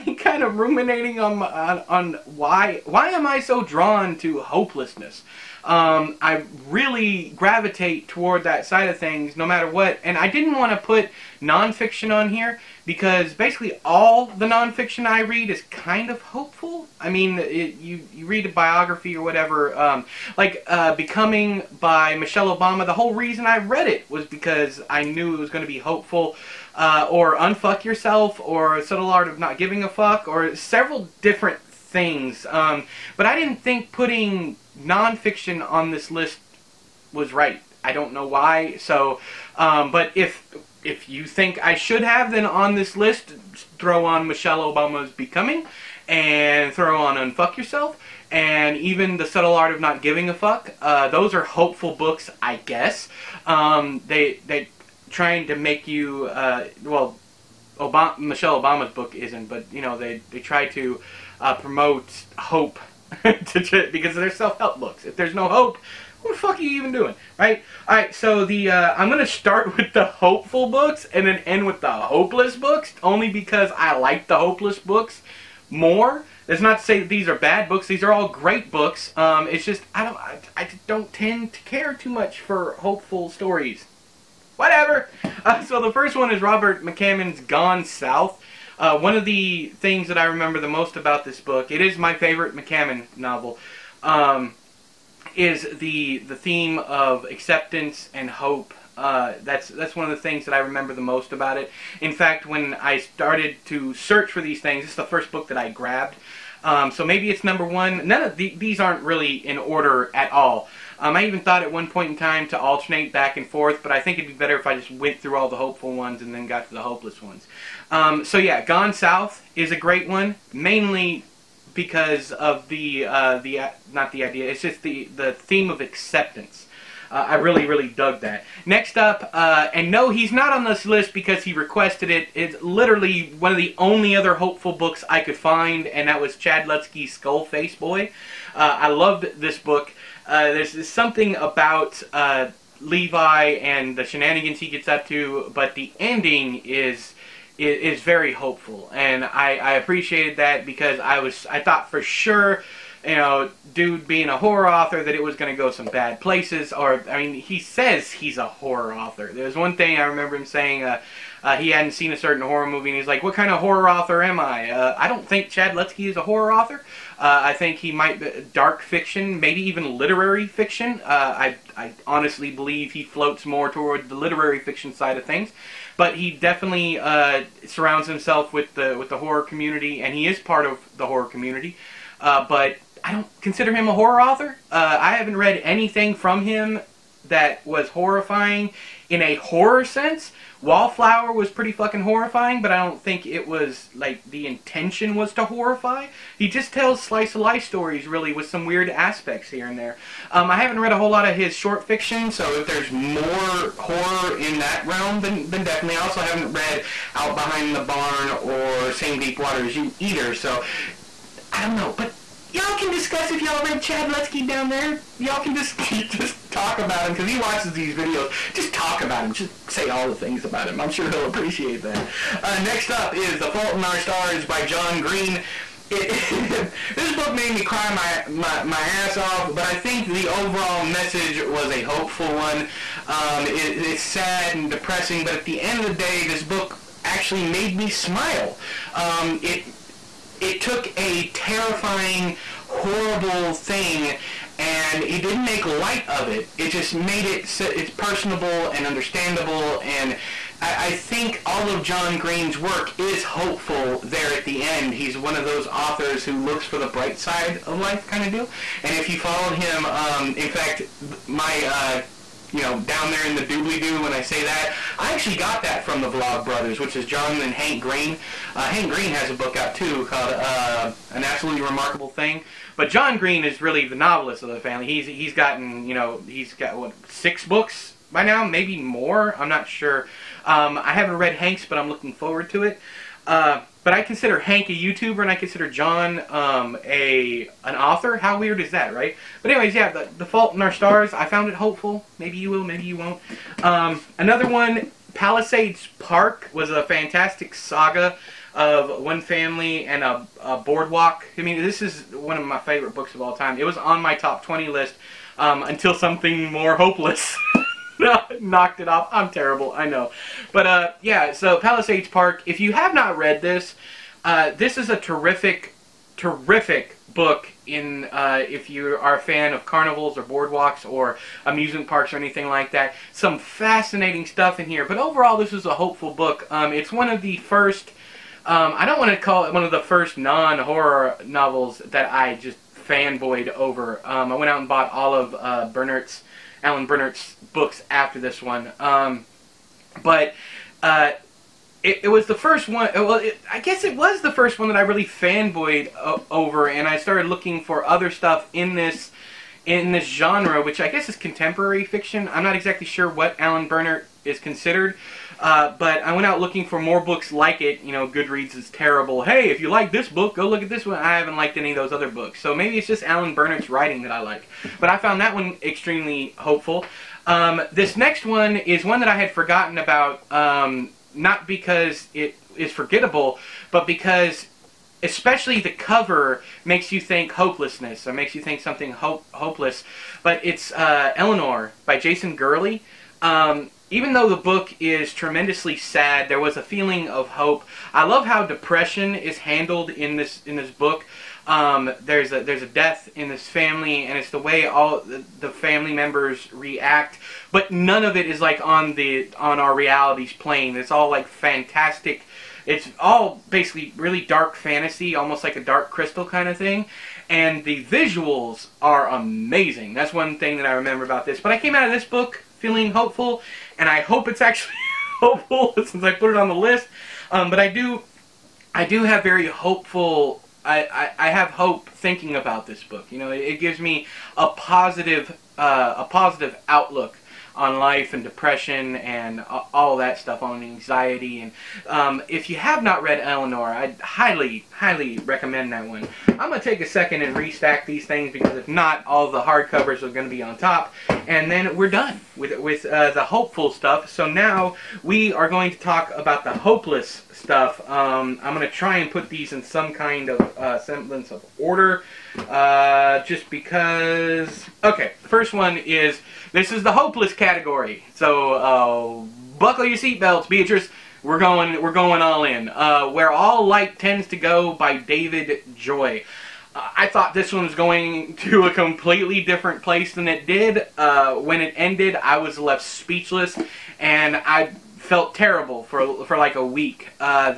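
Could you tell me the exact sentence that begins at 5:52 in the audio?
I'm not exactly sure what Alan Brennert is considered.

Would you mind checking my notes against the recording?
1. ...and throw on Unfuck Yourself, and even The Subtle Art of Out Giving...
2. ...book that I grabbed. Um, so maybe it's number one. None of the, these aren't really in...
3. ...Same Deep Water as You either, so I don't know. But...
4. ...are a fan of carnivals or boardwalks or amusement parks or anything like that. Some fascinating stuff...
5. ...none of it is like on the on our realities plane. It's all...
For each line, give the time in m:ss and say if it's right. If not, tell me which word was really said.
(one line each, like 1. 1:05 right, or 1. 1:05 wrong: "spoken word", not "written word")
1. 0:46 wrong: "Not", not "Out"
2. 1:45 right
3. 3:28 right
4. 5:18 right
5. 6:37 right.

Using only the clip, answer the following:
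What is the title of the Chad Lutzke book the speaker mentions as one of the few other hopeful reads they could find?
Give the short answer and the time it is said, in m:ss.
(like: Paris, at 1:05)
Skull Face Boy, at 2:17.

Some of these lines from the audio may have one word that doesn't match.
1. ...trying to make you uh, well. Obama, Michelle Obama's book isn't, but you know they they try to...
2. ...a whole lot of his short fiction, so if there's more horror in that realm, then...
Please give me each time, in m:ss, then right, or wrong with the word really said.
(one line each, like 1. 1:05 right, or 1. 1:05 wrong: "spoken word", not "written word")
1. 0:55 right
2. 3:20 right.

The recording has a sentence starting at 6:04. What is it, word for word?
But I found that one extremely hopeful.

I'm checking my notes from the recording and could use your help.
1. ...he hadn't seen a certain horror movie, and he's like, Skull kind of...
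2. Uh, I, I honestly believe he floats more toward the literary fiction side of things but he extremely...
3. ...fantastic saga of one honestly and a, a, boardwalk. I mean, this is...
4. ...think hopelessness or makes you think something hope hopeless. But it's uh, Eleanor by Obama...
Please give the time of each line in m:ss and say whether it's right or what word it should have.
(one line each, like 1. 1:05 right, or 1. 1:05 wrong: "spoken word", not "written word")
1. 2:41 wrong: "What", not "Skull"
2. 2:51 wrong: "definitely", not "extremely"
3. 4:56 wrong: "family", not "honestly"
4. 6:16 wrong: "Jason", not "Obama".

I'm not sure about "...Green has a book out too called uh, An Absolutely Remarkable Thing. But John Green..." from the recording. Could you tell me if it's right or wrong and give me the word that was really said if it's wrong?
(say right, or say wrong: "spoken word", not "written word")
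right.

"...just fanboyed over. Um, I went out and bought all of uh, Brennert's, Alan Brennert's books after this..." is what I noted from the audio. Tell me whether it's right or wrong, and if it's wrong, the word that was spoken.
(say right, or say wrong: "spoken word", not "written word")
right.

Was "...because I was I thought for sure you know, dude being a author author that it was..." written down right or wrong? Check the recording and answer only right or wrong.
wrong.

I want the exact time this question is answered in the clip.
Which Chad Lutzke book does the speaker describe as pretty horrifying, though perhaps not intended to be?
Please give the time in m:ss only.
3:10.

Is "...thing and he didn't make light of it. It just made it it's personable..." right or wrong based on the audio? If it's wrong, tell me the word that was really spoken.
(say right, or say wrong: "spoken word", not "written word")
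right.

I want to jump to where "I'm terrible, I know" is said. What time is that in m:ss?
5:09.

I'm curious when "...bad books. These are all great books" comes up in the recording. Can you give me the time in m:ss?
1:17.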